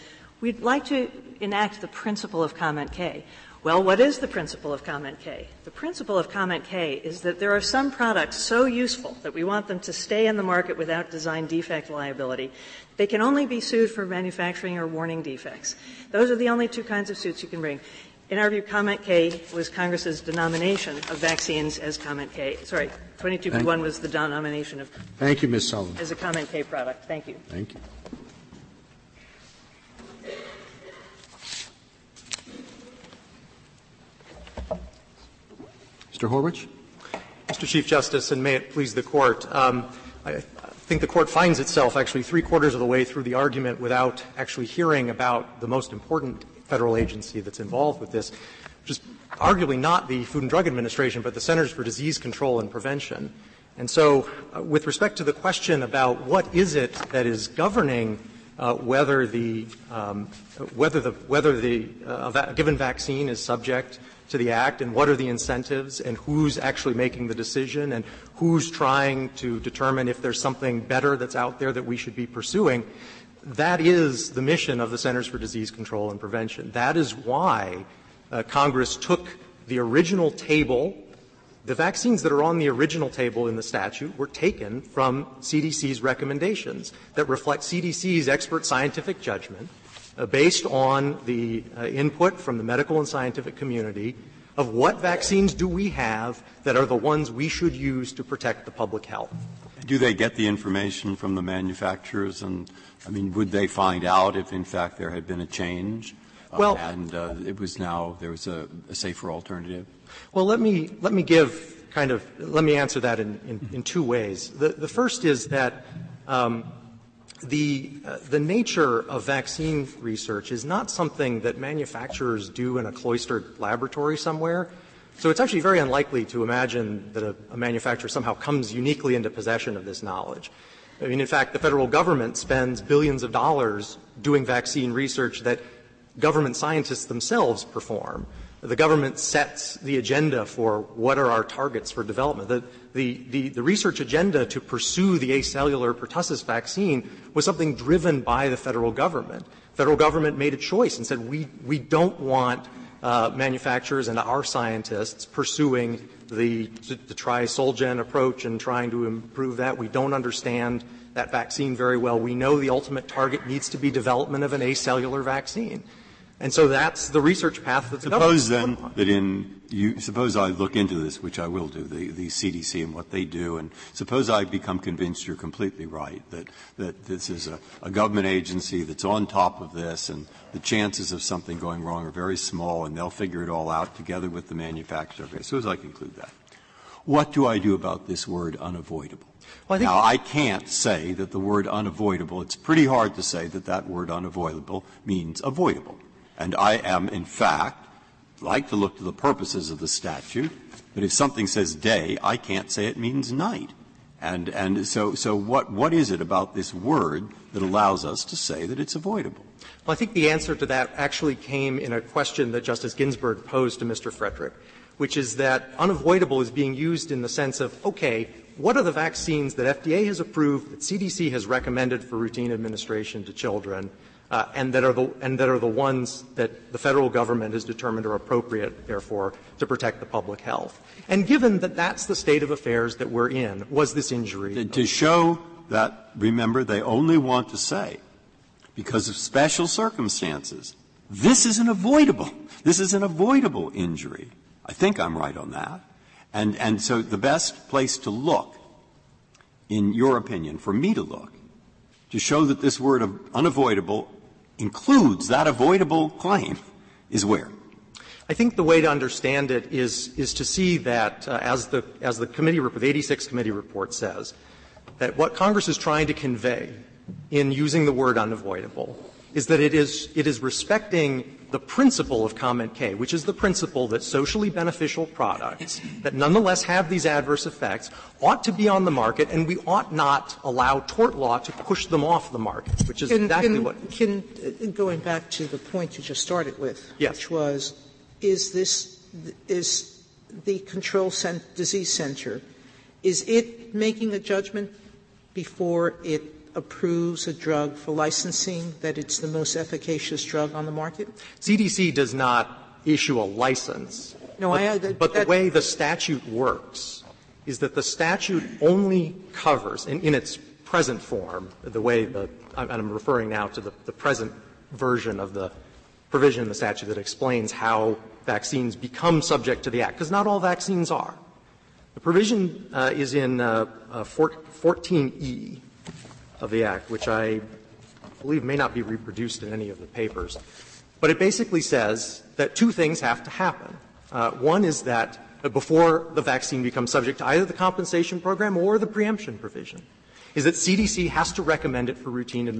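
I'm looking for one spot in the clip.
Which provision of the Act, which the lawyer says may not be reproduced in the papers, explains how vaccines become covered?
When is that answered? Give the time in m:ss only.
5:24.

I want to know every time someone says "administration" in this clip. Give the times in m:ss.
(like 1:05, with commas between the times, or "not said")
0:50, 3:42.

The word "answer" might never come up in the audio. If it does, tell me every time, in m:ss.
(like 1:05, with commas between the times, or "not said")
1:52, 3:30.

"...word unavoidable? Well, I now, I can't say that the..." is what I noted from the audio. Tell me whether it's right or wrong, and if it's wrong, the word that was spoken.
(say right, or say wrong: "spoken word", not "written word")
right.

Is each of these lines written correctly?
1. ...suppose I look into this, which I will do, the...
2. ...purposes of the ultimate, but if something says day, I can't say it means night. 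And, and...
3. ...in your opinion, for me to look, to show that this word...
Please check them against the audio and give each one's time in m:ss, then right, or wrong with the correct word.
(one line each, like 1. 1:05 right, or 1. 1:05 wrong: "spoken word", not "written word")
1. 2:49 right
2. 3:19 wrong: "statute", not "ultimate"
3. 4:09 right.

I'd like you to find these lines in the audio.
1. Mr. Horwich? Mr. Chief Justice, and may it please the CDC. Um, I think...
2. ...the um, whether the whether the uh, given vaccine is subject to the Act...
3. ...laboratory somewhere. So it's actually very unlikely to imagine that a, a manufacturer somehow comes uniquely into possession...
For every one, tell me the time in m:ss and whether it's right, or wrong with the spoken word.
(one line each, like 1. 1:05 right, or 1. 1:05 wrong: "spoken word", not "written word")
1. 0:36 wrong: "Court", not "CDC"
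2. 0:59 right
3. 2:03 right.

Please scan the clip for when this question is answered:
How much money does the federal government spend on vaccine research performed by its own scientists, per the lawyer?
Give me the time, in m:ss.
2:12.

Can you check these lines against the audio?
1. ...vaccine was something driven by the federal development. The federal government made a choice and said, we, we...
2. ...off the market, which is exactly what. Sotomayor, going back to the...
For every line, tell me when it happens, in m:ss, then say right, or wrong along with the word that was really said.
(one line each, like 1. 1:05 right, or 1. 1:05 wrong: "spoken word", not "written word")
1. 2:26 wrong: "government", not "development"
2. 4:42 right.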